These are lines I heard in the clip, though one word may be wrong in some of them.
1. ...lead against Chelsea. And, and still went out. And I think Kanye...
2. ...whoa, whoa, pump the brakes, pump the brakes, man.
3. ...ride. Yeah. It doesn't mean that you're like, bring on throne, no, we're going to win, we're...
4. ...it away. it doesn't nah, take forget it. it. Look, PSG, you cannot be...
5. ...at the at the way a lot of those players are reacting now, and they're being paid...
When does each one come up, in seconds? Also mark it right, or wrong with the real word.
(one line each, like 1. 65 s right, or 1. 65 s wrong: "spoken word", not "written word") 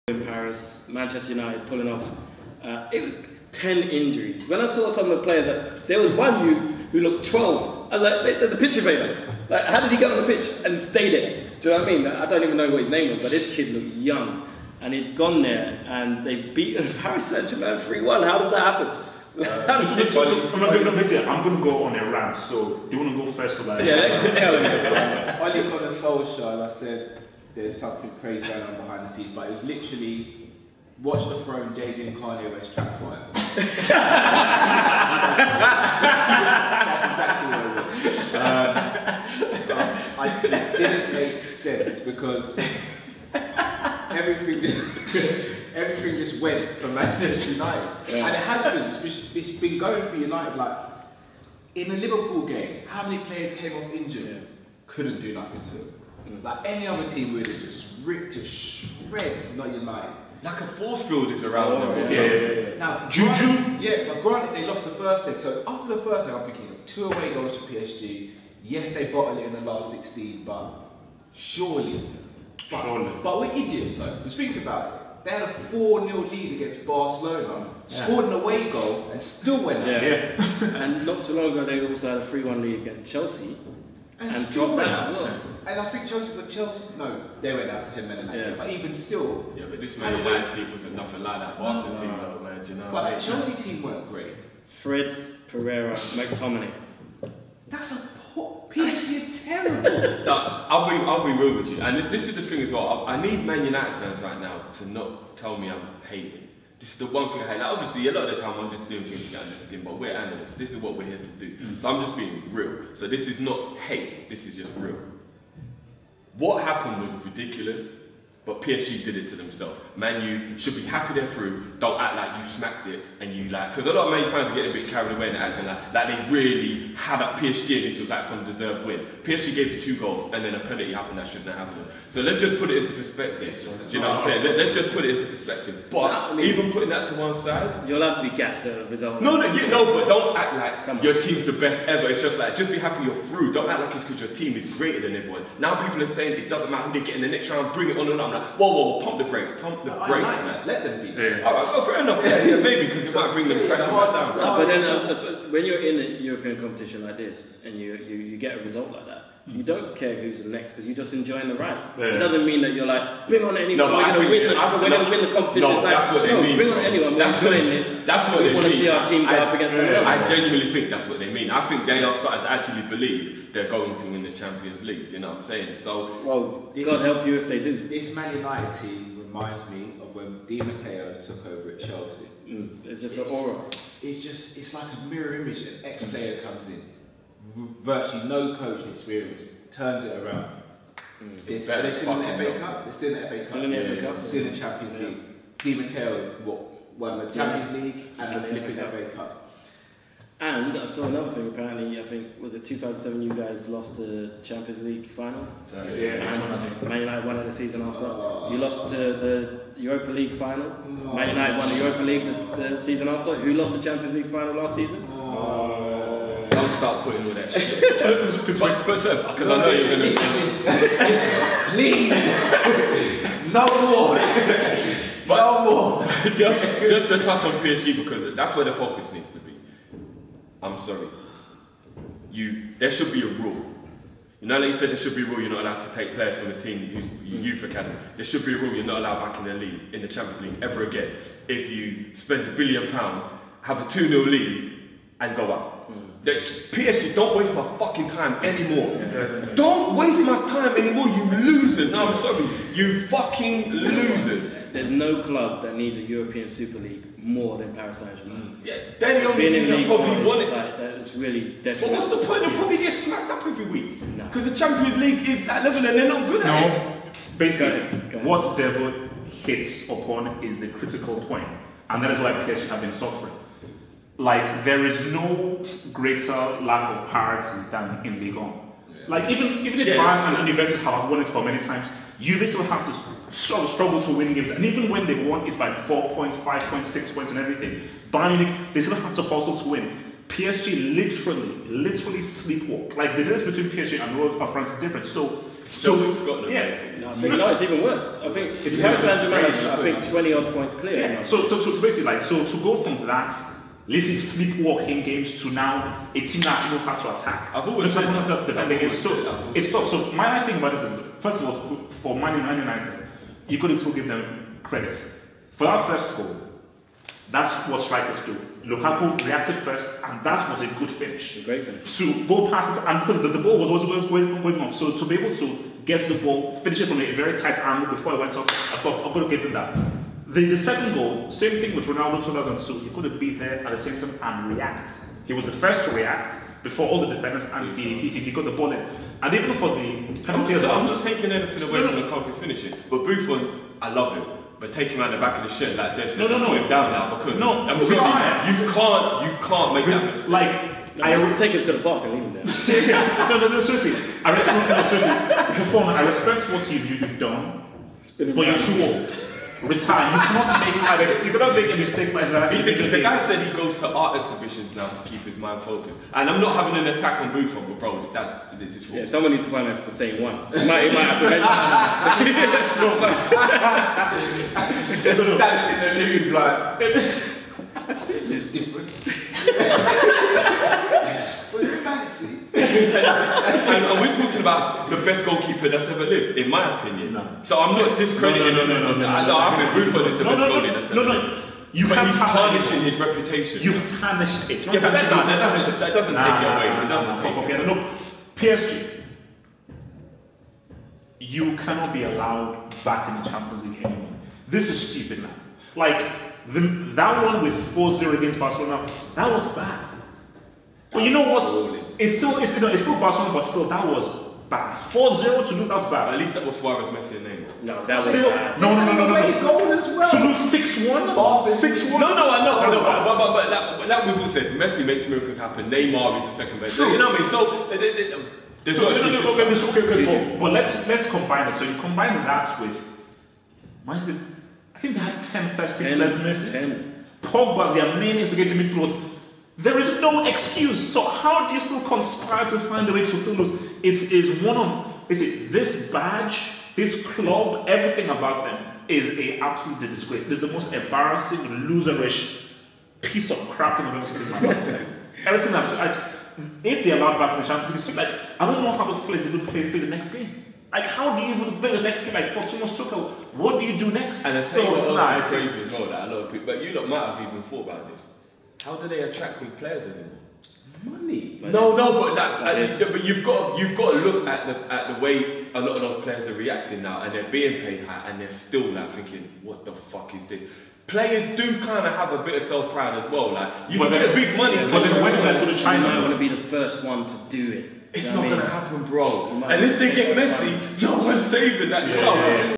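1. 82 s wrong: "Chelsea", not "Kanye"
2. 148 s right
3. 161 s wrong: "anyone", not "throne"
4. 396 s right
5. 474 s right.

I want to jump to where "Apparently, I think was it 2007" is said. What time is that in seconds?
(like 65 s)
201 s.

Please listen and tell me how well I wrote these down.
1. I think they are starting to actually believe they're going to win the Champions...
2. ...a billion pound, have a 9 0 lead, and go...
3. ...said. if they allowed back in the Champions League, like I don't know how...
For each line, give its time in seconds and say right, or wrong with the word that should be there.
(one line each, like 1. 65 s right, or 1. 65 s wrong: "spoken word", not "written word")
1. 171 s right
2. 242 s wrong: "2", not "9"
3. 455 s right.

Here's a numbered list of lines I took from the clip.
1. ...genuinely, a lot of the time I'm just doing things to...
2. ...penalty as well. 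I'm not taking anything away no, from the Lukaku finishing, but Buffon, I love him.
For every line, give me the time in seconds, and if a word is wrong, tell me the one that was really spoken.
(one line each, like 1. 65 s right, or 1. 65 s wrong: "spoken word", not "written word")
1. 107 s wrong: "obviously", not "genuinely"
2. 340 s right.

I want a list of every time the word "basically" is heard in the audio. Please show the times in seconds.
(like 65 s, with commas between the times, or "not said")
267 s, 301 s.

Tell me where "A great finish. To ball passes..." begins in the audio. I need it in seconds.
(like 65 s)
321 s.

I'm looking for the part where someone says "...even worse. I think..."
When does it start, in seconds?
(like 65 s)
297 s.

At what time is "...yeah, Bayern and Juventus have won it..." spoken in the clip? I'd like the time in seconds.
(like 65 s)
279 s.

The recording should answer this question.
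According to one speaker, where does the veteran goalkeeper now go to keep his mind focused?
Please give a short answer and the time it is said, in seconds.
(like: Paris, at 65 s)
art exhibitions, at 363 s.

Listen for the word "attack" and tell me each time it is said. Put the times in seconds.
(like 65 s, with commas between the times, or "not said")
307 s, 366 s.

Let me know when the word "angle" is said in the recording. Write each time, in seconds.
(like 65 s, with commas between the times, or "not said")
327 s.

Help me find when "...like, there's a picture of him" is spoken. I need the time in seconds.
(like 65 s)
8 s.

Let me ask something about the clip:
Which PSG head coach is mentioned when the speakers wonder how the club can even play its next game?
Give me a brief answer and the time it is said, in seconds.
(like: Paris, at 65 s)
Thomas Tuchel, at 462 s.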